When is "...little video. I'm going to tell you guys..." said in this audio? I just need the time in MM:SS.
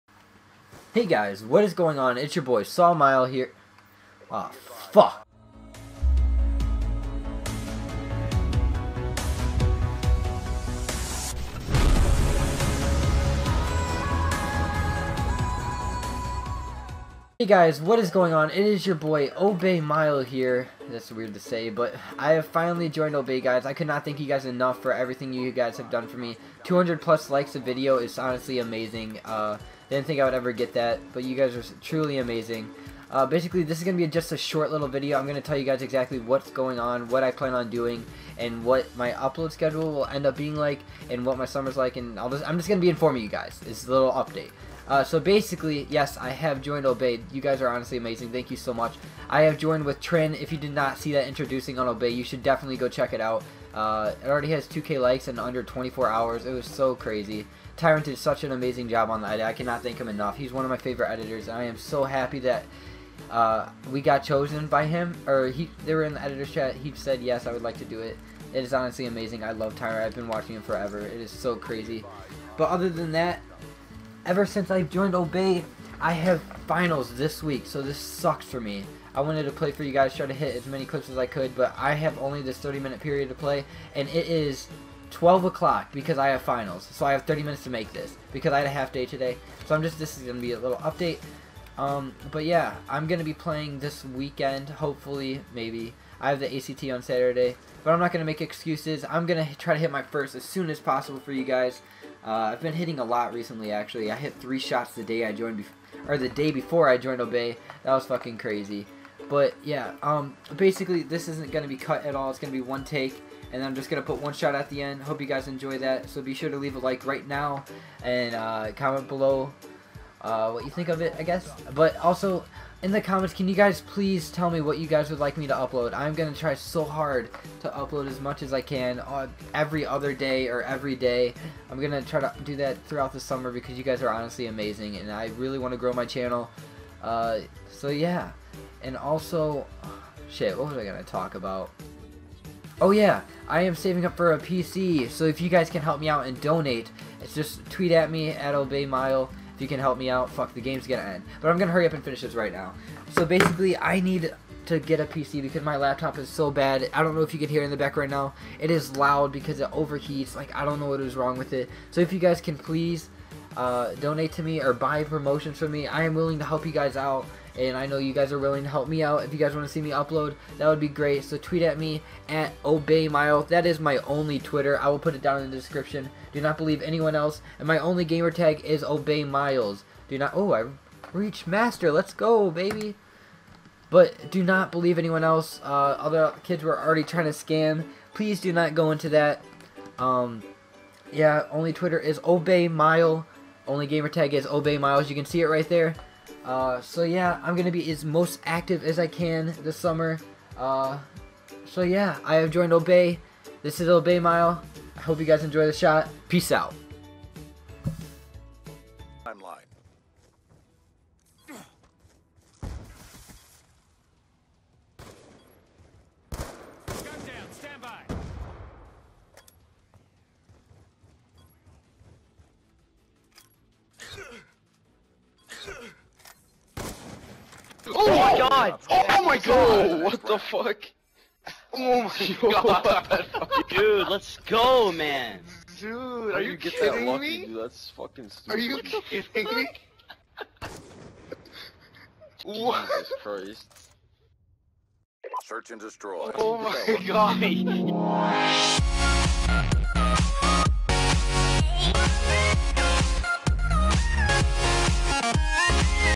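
00:34.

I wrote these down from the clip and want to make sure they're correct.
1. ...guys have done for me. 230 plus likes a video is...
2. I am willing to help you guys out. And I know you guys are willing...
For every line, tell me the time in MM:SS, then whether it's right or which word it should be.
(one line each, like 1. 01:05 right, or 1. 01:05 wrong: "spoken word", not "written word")
1. 00:25 wrong: "200", not "230"
2. 02:45 right.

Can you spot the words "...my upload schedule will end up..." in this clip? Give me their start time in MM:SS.
00:38.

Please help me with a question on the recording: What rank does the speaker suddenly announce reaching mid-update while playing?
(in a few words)
Master.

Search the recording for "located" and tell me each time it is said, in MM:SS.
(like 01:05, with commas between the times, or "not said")
not said.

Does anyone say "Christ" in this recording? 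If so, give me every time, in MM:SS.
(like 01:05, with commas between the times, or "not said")
04:03.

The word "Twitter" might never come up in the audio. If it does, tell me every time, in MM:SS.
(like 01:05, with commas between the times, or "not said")
02:54, 03:11.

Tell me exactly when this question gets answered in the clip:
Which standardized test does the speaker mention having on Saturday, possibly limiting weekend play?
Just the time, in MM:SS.
01:36.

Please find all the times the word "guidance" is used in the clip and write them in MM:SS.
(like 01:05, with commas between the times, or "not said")
not said.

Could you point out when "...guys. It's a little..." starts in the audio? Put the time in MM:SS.
00:43.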